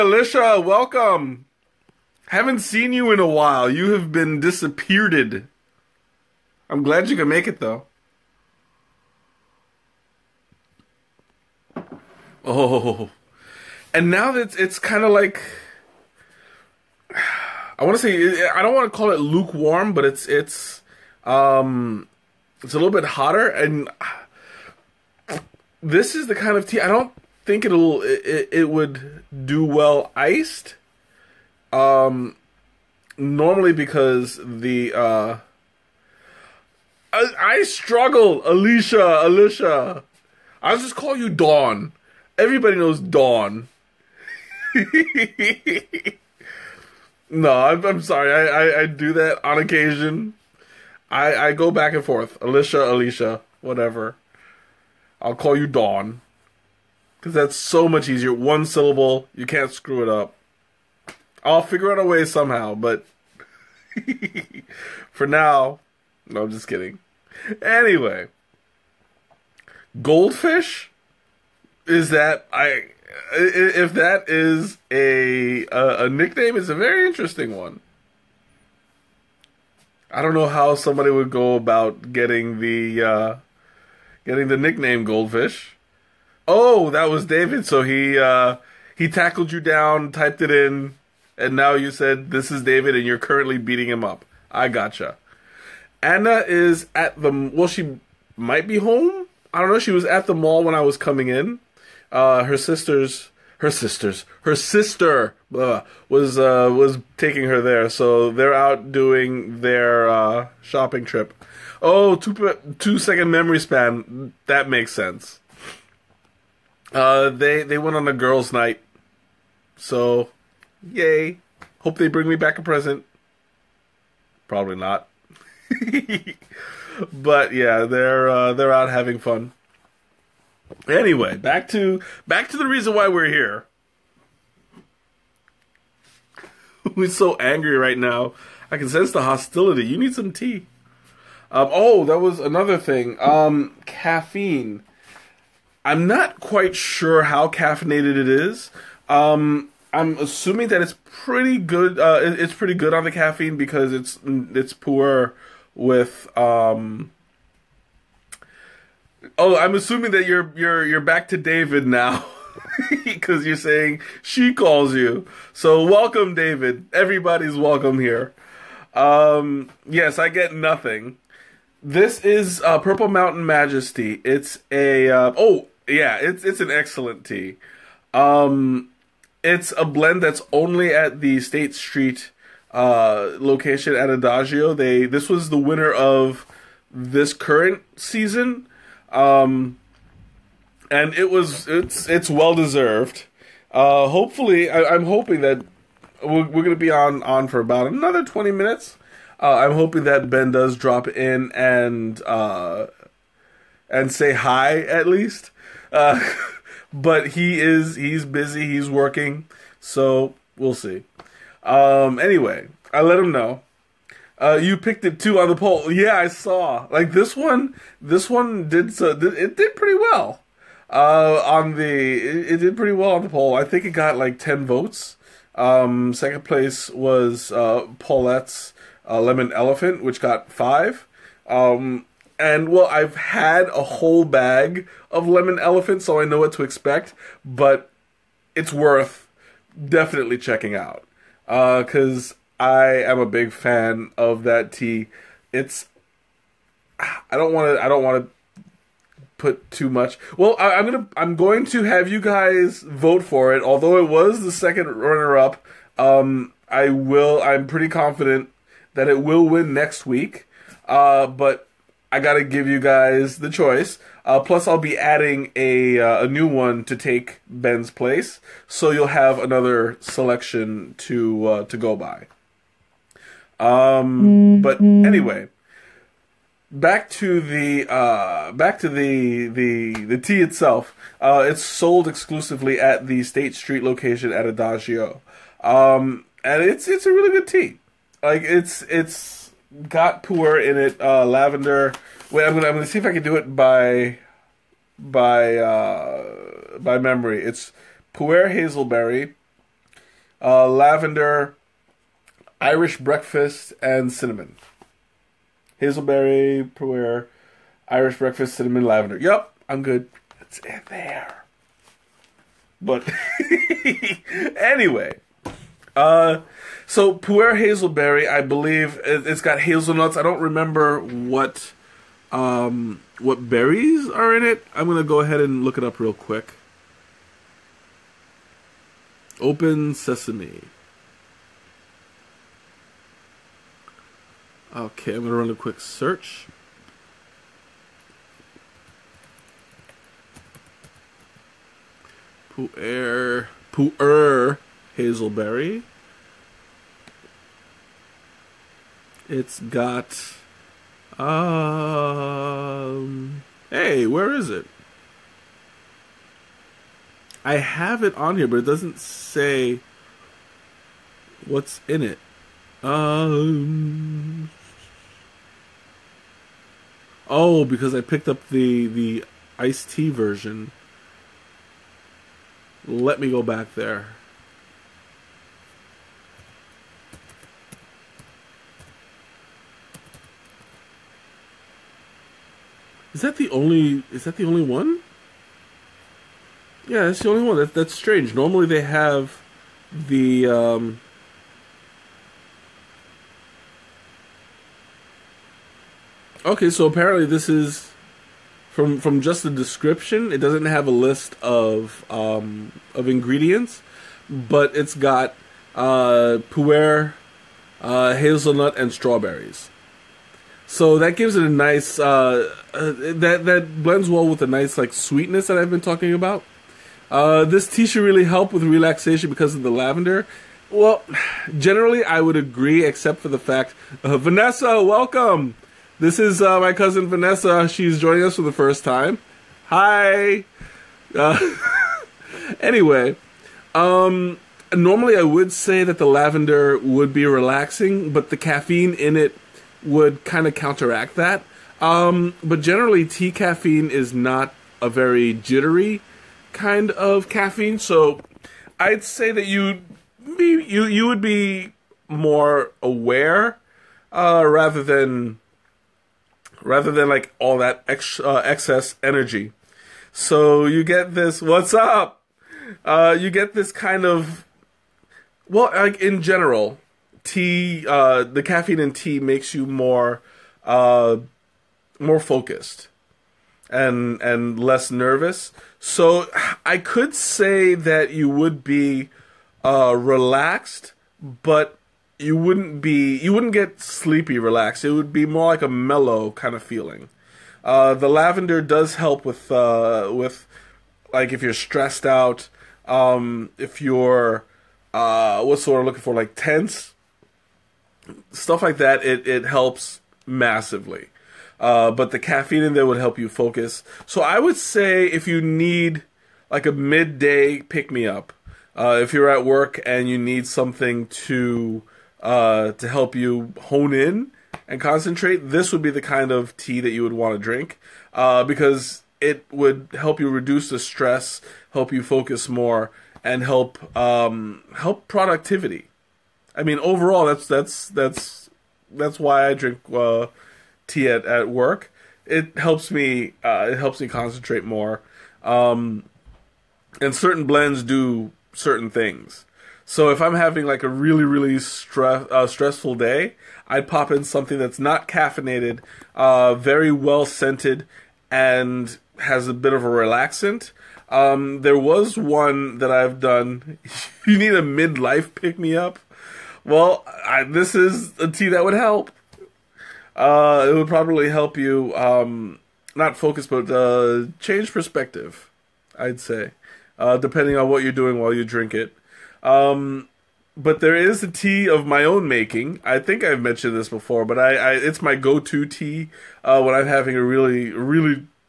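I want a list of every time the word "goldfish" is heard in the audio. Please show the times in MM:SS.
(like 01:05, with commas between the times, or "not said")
01:10, 01:25.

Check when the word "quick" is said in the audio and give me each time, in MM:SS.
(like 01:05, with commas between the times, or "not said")
05:26, 05:35.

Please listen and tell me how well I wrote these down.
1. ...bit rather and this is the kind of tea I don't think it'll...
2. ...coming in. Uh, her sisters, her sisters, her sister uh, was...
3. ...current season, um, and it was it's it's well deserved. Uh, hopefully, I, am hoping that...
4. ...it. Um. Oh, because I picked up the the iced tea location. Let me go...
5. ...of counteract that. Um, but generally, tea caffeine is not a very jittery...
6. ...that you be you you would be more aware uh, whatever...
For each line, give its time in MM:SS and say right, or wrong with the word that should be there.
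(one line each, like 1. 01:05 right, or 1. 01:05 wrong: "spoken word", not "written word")
1. 00:22 wrong: "hotter", not "rather"
2. 01:40 right
3. 03:07 right
4. 06:02 wrong: "version", not "location"
5. 07:20 right
6. 07:29 wrong: "rather", not "whatever".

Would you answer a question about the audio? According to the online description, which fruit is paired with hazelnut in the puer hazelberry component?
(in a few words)
strawberries.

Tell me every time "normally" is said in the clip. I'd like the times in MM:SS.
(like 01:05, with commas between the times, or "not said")
00:33, 06:28, 07:14.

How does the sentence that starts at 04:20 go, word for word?
Uh, but I gotta give you guys the choice.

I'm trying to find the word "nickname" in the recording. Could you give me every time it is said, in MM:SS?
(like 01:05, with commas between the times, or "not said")
01:16, 01:24.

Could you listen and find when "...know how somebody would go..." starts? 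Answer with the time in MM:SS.
01:20.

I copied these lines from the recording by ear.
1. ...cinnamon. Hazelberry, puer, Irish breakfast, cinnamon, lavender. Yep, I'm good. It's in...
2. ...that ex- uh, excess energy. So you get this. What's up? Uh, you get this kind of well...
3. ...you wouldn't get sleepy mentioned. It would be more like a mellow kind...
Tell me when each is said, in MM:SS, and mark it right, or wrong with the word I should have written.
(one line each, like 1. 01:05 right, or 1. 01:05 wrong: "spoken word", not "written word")
1. 05:04 right
2. 07:37 right
3. 08:03 wrong: "relaxed", not "mentioned".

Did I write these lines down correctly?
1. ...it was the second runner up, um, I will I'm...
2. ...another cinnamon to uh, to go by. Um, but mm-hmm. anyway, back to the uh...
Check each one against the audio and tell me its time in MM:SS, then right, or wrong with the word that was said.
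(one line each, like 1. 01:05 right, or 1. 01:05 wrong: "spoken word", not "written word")
1. 04:13 right
2. 04:29 wrong: "selection", not "cinnamon".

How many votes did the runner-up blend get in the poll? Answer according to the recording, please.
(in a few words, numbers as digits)
5.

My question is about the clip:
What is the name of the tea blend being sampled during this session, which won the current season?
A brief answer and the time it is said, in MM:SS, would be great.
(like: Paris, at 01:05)
Purple Mountain Majesty, at 02:52.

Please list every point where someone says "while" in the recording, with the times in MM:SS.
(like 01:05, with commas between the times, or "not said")
00:03, 09:28.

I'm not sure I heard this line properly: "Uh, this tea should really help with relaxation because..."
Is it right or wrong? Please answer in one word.
right.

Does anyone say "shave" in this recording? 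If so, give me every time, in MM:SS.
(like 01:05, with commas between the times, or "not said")
not said.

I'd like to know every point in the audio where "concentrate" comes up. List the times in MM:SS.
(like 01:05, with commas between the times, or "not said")
08:34, 08:54.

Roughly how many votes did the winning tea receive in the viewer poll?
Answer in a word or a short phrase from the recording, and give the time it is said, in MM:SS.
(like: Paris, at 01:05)
10, at 03:44.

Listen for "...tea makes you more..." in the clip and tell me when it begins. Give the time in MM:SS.
07:48.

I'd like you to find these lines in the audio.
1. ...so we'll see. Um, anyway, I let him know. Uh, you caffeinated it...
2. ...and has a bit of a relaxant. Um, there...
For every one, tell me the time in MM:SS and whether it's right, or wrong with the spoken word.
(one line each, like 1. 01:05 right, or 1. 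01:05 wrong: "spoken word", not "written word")
1. 03:29 wrong: "picked", not "caffeinated"
2. 09:08 right.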